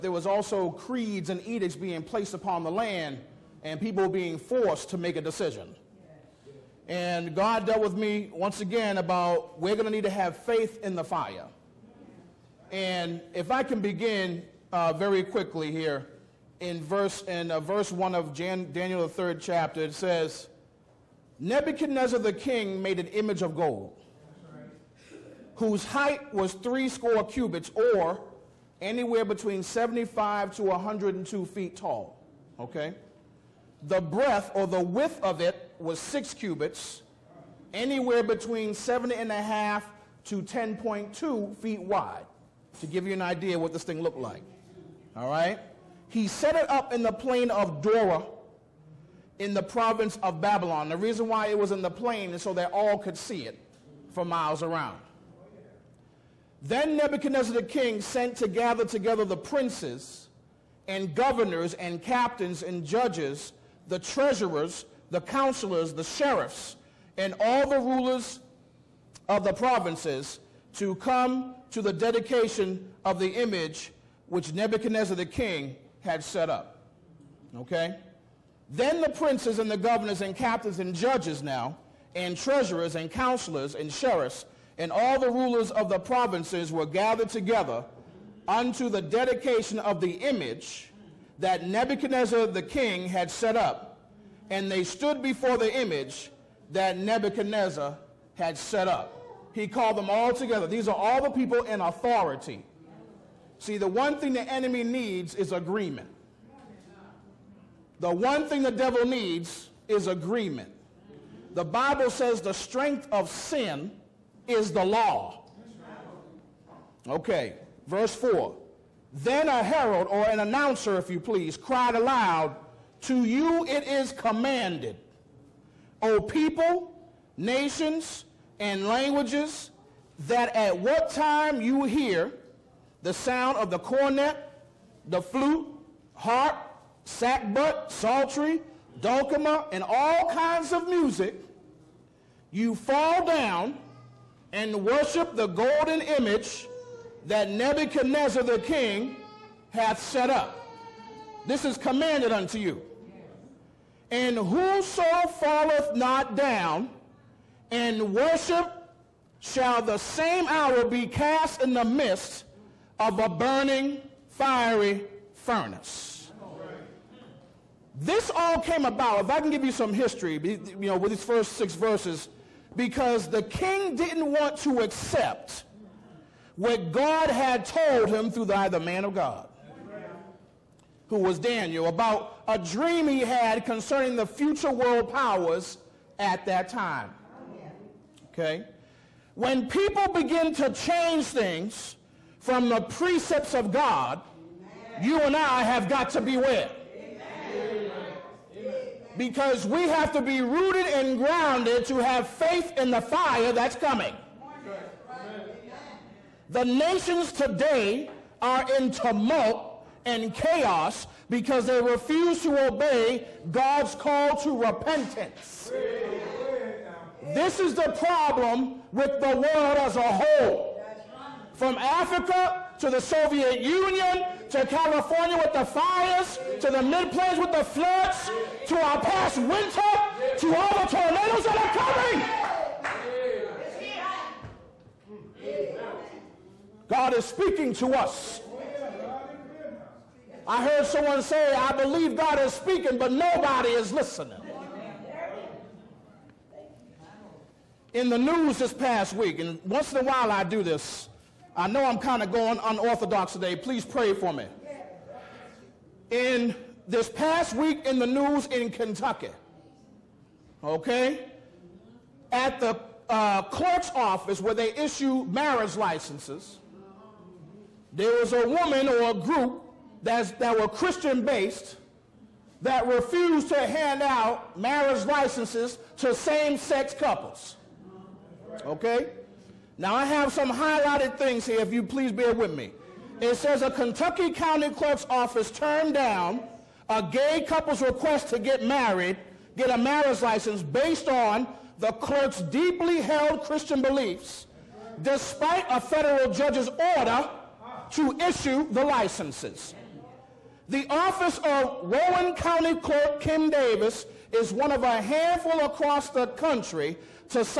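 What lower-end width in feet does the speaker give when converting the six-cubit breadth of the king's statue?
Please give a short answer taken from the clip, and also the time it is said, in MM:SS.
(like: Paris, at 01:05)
7.5 feet, at 00:38.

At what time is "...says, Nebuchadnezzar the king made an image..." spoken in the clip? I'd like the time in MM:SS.
00:19.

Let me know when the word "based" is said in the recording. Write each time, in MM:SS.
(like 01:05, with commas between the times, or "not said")
04:31, 04:50.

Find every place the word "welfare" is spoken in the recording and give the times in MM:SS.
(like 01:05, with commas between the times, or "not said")
not said.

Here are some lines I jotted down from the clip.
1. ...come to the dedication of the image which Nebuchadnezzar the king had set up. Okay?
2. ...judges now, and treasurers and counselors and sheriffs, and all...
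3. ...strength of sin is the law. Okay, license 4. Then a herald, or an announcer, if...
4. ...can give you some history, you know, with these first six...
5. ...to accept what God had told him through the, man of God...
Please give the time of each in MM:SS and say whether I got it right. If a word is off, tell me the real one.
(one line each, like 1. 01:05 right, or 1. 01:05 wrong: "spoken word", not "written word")
1. 01:10 right
2. 01:20 right
3. 01:52 wrong: "verse", not "license"
4. 02:49 right
5. 02:54 right.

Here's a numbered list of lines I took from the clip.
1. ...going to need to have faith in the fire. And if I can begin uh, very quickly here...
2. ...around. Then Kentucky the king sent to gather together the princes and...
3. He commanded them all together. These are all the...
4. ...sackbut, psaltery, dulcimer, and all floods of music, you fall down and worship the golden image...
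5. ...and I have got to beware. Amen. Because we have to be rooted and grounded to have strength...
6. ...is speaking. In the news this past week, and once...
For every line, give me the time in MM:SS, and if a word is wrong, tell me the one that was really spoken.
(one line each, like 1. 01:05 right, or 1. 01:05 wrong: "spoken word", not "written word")
1. 00:09 right
2. 00:54 wrong: "Nebuchadnezzar", not "Kentucky"
3. 01:39 wrong: "called", not "commanded"
4. 02:17 wrong: "kinds", not "floods"
5. 03:15 wrong: "faith", not "strength"
6. 04:03 wrong: "listening", not "speaking".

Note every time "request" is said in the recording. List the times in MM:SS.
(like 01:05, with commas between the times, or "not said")
04:47.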